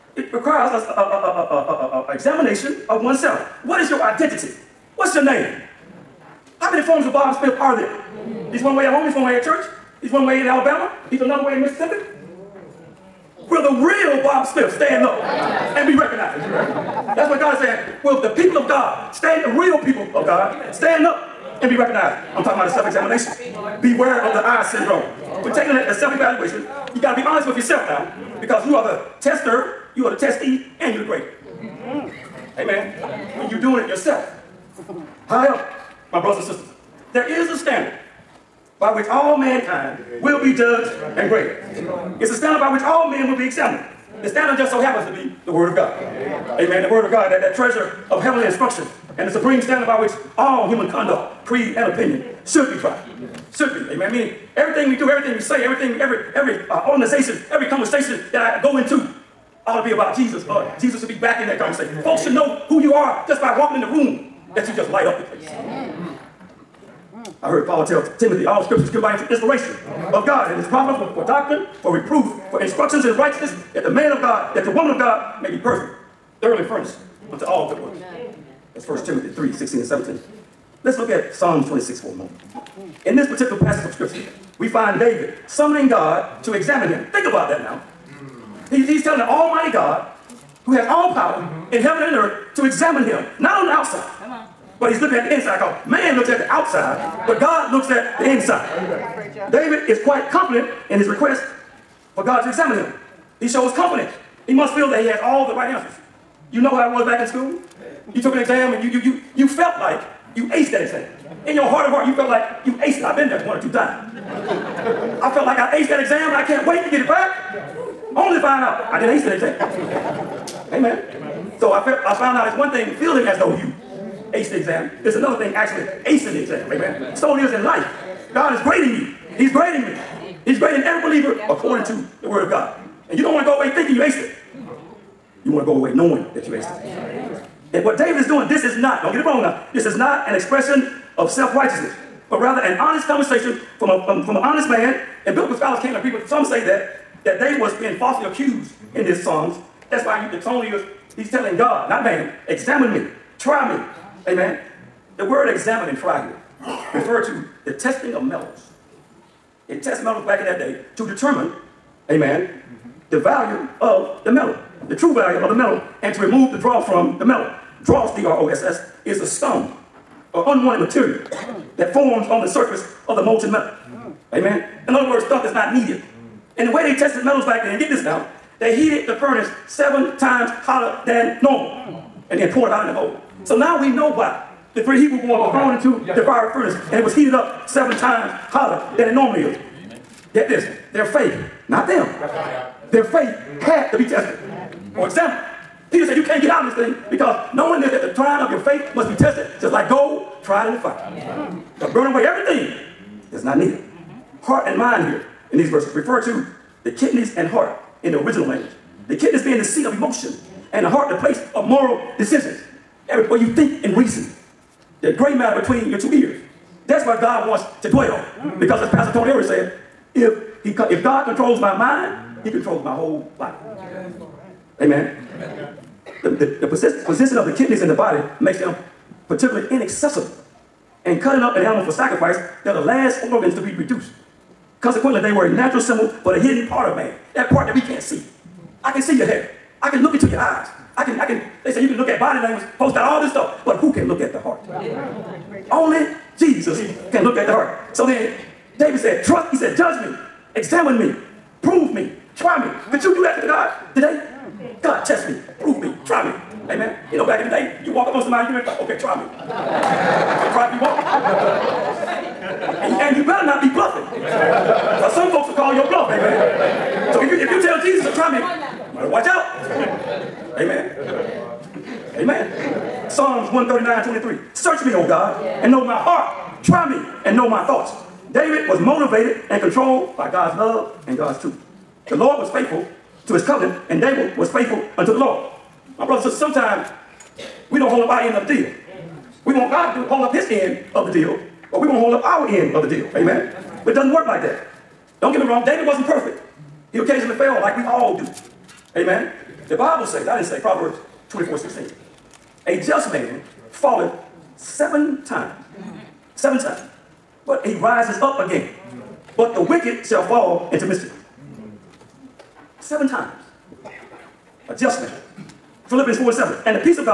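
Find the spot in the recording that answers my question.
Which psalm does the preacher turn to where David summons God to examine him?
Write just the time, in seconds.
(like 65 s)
81 s.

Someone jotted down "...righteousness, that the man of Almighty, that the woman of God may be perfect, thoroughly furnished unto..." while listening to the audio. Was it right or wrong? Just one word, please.
wrong.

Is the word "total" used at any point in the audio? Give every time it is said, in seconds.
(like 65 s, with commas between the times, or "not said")
not said.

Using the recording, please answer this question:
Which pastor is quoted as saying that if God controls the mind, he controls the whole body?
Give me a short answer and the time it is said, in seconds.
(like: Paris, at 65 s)
Pastor Tony Eric, at 218 s.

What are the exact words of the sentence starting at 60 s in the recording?
Uh, Jesus should be back in that conversation.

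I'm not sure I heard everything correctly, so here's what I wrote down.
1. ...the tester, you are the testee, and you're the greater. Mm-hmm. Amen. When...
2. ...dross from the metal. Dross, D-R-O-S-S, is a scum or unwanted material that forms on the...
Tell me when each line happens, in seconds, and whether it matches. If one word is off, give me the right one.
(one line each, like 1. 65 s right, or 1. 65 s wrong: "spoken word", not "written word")
1. 28 s right
2. 166 s right.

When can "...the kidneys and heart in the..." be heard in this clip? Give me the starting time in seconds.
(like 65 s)
206 s.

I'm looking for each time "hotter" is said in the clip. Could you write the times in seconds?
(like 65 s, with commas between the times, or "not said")
180 s, 188 s.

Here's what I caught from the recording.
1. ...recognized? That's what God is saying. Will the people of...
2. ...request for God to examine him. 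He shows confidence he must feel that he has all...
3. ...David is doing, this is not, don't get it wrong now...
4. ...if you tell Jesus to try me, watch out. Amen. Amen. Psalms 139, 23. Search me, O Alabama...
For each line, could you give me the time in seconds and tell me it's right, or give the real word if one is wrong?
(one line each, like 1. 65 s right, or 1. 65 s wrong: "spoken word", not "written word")
1. 15 s right
2. 101 s right
3. 137 s right
4. 267 s wrong: "God", not "Alabama".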